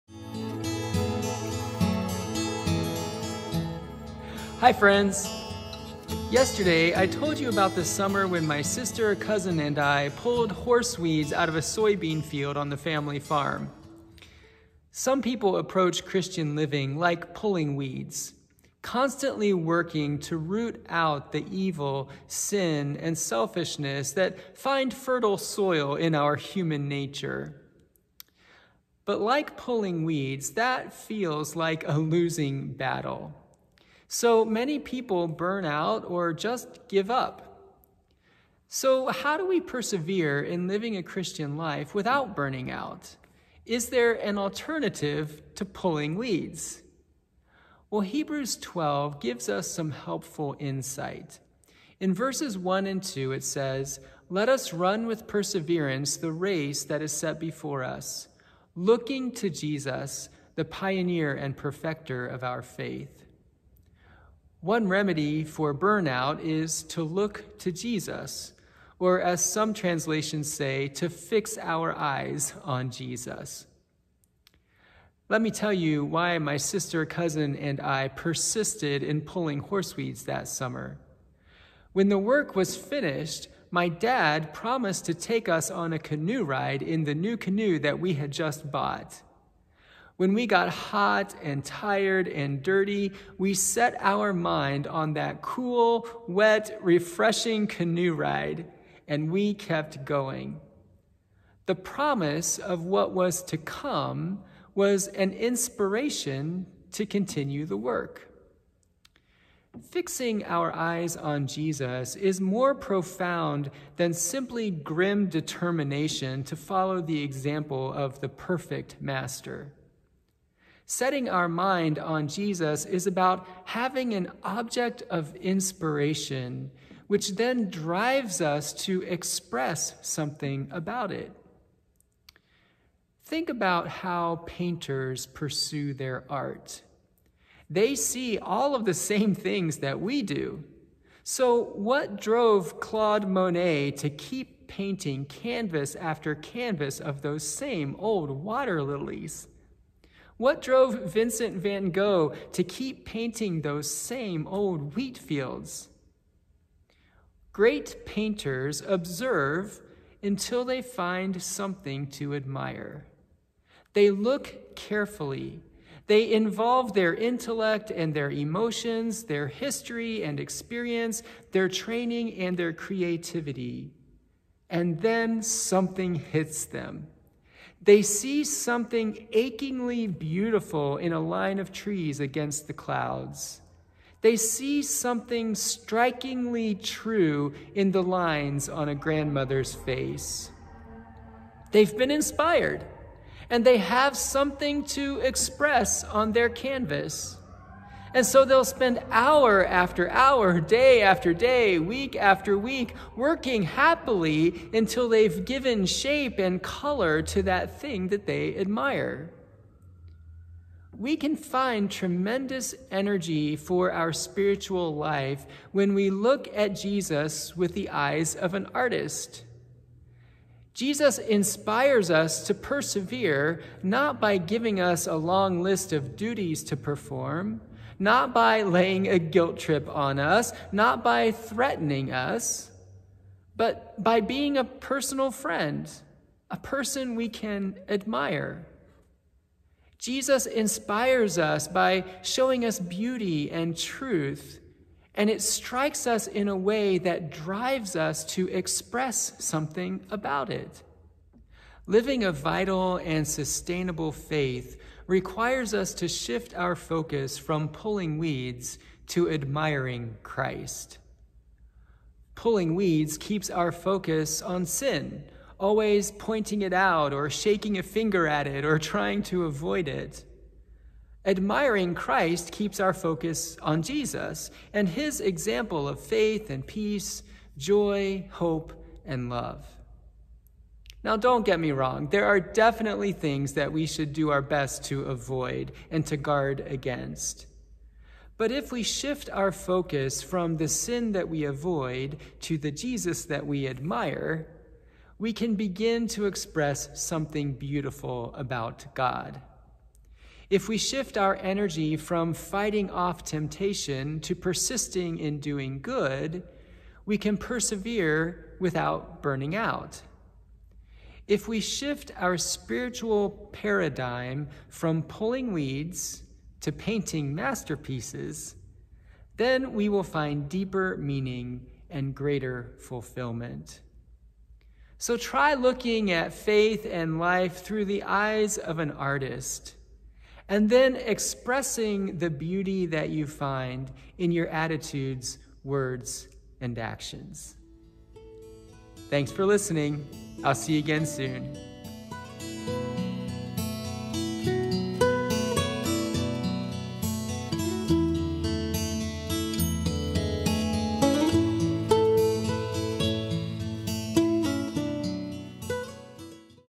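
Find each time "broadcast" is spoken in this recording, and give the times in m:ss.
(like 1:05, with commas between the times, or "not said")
not said.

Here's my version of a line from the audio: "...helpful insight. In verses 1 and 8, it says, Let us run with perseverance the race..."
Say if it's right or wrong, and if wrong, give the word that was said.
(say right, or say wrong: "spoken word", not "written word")
wrong: "2", not "8".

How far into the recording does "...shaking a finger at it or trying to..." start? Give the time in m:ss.
4:27.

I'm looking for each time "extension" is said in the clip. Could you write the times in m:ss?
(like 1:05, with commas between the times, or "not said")
not said.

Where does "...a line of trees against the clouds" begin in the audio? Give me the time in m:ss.
3:01.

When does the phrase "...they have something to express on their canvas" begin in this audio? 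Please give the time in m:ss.
3:13.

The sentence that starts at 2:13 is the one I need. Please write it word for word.
Think about how painters pursue their art.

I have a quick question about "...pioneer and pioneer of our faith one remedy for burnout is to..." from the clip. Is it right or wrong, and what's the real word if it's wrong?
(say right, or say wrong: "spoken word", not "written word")
wrong: "perfecter", not "pioneer".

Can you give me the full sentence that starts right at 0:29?
But like pulling weeds, that feels like a losing battle.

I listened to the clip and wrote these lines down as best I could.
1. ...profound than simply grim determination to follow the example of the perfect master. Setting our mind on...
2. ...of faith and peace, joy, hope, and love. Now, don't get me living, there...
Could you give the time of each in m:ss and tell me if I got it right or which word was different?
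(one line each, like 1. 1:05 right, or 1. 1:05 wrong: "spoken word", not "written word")
1. 1:52 right
2. 4:35 wrong: "wrong", not "living".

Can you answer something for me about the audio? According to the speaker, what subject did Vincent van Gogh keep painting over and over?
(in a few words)
wheat fields.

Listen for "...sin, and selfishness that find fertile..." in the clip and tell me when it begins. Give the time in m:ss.
0:22.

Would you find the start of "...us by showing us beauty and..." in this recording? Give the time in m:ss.
4:01.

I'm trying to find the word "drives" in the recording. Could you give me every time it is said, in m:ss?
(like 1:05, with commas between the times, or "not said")
2:07, 4:07.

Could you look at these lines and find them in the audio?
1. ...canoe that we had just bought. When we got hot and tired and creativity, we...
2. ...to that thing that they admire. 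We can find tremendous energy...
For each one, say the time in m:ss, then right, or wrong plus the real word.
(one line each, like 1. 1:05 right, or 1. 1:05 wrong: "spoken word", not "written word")
1. 1:27 wrong: "dirty", not "creativity"
2. 3:27 right.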